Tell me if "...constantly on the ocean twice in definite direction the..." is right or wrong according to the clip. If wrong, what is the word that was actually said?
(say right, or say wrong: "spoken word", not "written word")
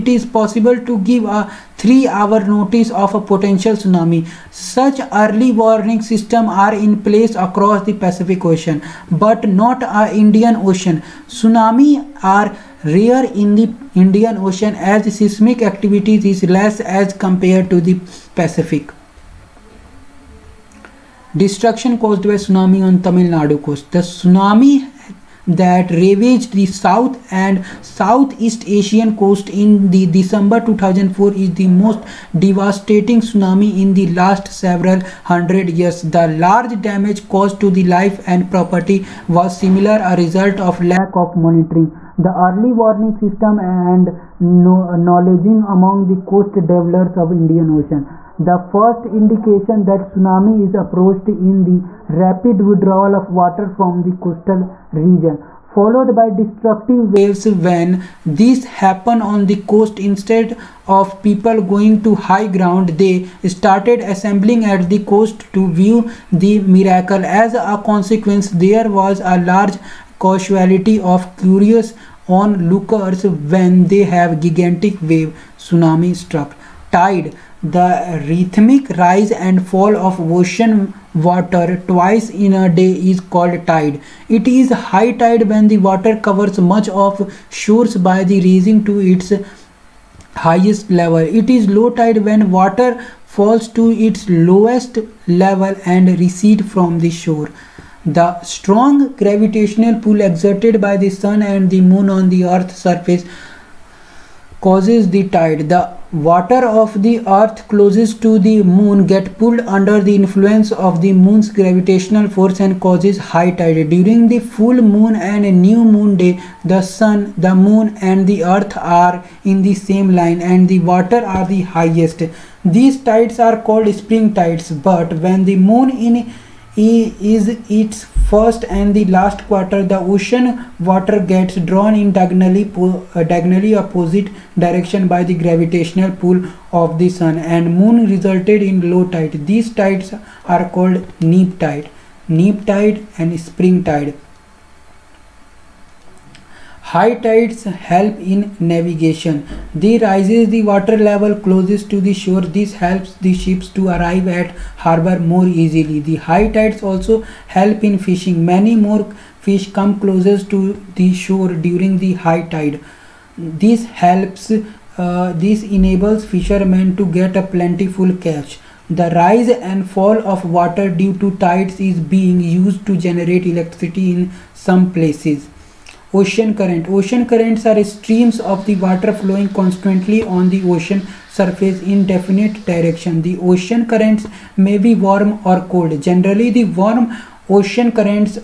wrong: "surface", not "twice".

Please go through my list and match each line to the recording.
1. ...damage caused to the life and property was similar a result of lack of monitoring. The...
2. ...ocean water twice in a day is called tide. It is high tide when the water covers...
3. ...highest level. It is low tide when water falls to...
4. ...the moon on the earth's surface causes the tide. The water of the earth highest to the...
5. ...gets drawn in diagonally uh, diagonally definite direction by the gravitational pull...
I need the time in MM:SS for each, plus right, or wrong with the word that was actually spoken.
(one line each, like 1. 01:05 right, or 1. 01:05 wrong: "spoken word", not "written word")
1. 00:36 right
2. 01:20 right
3. 01:30 right
4. 01:41 wrong: "closest", not "highest"
5. 02:11 wrong: "opposite", not "definite".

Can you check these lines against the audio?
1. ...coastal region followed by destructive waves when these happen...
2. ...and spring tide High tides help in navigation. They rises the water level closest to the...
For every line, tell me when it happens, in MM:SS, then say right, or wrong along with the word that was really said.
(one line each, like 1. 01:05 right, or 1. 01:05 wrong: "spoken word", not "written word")
1. 00:54 right
2. 02:23 right.